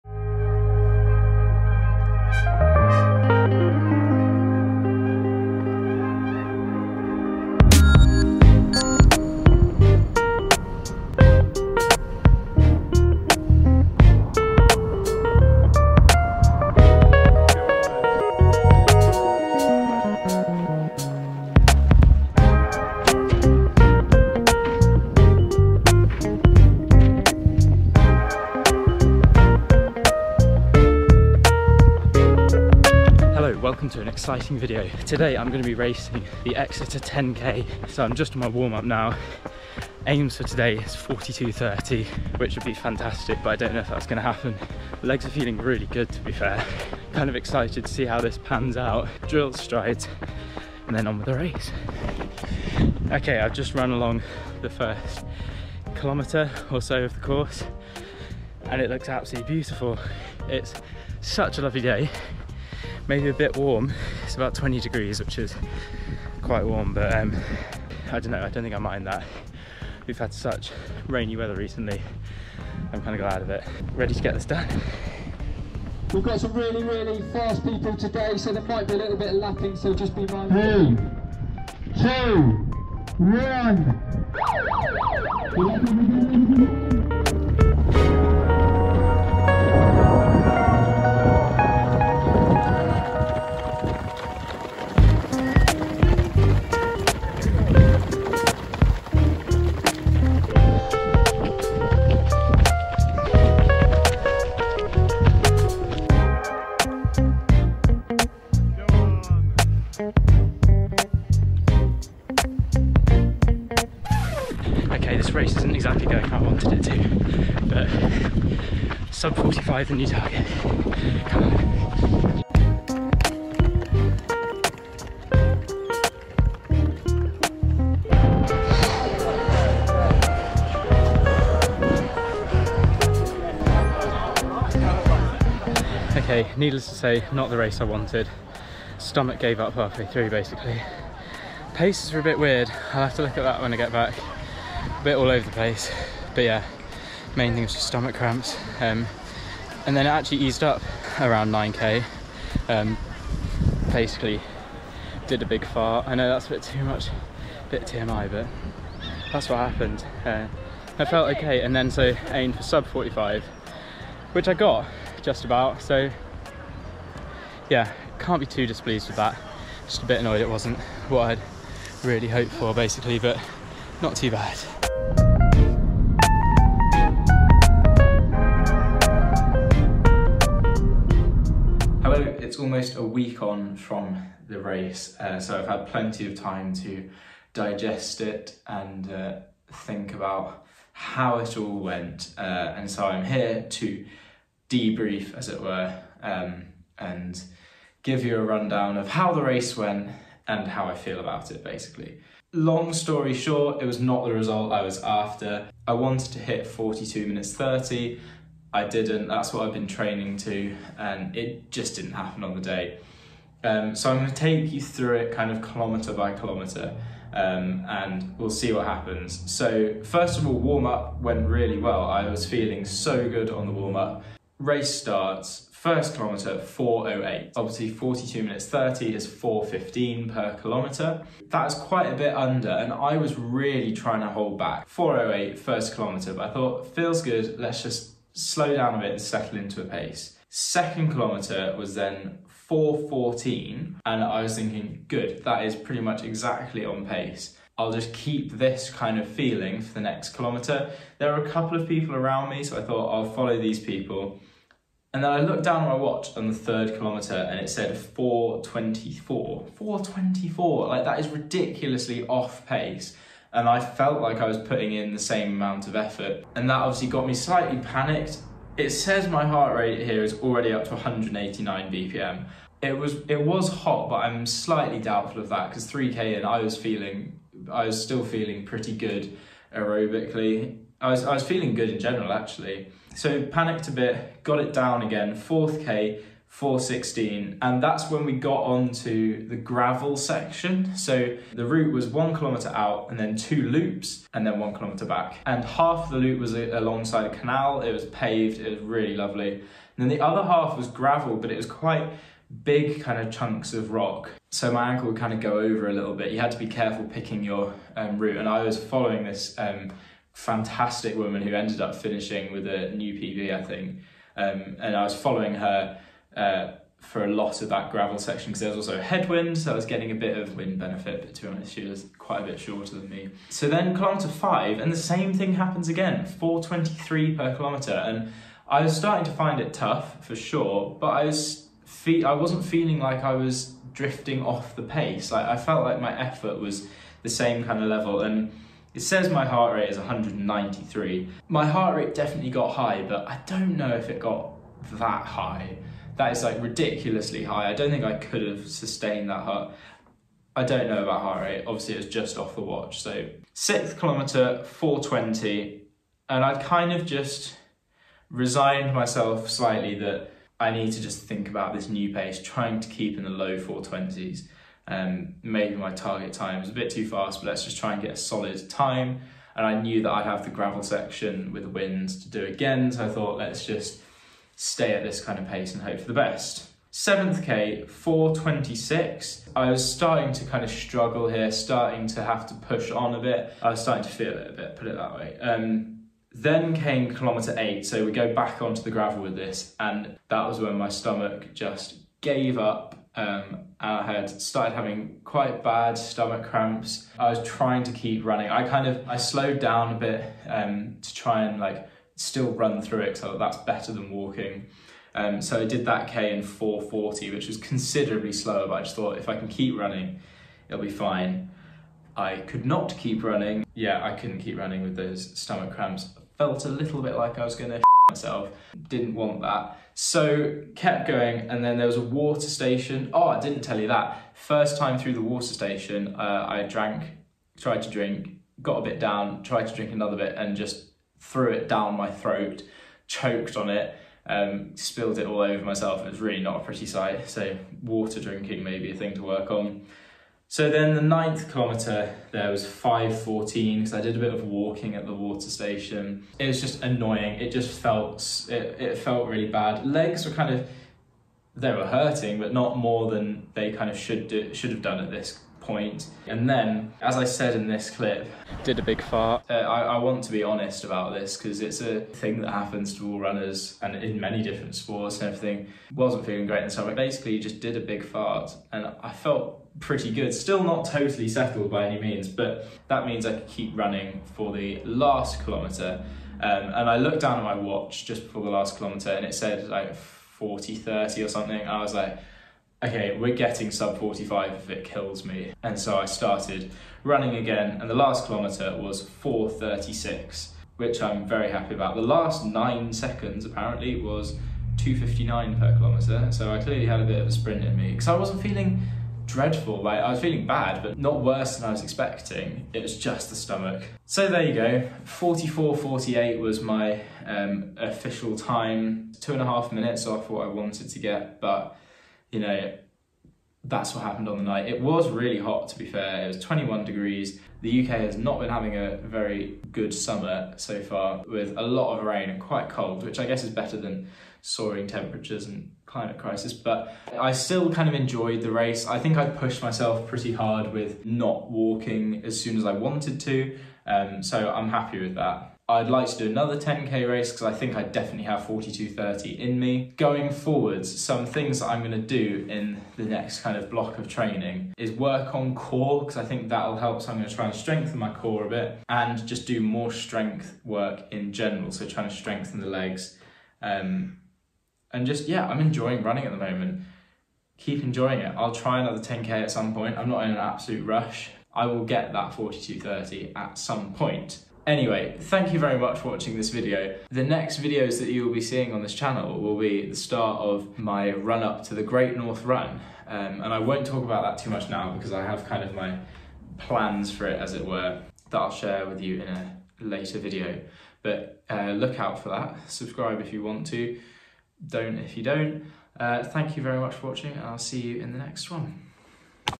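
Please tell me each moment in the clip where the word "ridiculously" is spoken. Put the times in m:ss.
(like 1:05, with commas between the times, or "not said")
4:21, 5:46.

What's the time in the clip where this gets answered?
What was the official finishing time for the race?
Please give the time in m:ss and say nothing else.
8:25.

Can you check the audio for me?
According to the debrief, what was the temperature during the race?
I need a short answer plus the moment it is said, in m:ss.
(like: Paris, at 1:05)
21 degrees, at 8:36.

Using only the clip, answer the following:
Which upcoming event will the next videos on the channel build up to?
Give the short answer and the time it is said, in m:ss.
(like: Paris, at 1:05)
Great North Run, at 9:31.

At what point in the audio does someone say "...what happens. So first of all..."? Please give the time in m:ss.
3:38.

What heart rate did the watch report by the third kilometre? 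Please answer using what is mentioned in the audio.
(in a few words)
189 BPM.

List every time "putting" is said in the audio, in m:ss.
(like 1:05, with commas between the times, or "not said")
4:24.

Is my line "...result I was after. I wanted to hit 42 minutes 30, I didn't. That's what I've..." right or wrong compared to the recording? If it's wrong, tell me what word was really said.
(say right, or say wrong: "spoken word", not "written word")
right.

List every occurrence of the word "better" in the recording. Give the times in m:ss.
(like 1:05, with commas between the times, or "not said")
6:43, 8:43.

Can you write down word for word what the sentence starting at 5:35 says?
Like I felt like my effort was the same kind of level, and it says my heart rate is 193.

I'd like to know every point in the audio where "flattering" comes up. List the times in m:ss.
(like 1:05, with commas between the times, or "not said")
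not said.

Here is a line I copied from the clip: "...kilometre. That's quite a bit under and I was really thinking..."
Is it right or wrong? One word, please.
wrong.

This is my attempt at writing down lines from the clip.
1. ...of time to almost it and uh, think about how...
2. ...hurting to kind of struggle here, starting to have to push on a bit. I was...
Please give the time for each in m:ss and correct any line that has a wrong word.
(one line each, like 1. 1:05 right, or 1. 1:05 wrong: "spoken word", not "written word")
1. 3:06 wrong: "digest", not "almost"
2. 6:19 wrong: "starting", not "hurting".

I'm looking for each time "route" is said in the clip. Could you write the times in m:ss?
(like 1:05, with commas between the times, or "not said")
4:51, 5:08.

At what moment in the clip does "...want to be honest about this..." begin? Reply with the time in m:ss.
7:39.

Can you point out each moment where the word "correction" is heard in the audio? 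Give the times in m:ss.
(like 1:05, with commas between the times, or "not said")
not said.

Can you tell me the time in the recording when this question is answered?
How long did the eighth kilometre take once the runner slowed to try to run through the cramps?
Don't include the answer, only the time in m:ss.
6:46.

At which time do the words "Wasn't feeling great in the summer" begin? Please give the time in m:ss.
7:45.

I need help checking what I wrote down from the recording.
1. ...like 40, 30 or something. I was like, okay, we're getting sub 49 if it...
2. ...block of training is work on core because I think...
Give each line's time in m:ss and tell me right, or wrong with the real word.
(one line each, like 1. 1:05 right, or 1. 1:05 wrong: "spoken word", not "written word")
1. 7:59 wrong: "45", not "49"
2. 9:03 right.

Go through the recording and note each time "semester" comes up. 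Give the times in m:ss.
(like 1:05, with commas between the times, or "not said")
not said.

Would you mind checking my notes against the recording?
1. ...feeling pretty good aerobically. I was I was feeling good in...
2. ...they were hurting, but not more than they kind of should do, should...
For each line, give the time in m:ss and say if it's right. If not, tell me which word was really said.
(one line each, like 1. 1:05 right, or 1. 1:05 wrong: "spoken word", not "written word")
1. 4:38 right
2. 7:31 right.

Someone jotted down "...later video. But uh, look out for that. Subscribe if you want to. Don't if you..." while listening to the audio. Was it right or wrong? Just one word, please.
right.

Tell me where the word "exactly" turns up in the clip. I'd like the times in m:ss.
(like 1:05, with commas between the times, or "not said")
1:55, 4:06.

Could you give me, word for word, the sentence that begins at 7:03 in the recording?
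Oh, I didn't tell you that.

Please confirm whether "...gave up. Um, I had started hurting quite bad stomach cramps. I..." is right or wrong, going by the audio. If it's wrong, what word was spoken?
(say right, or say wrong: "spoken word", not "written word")
wrong: "having", not "hurting".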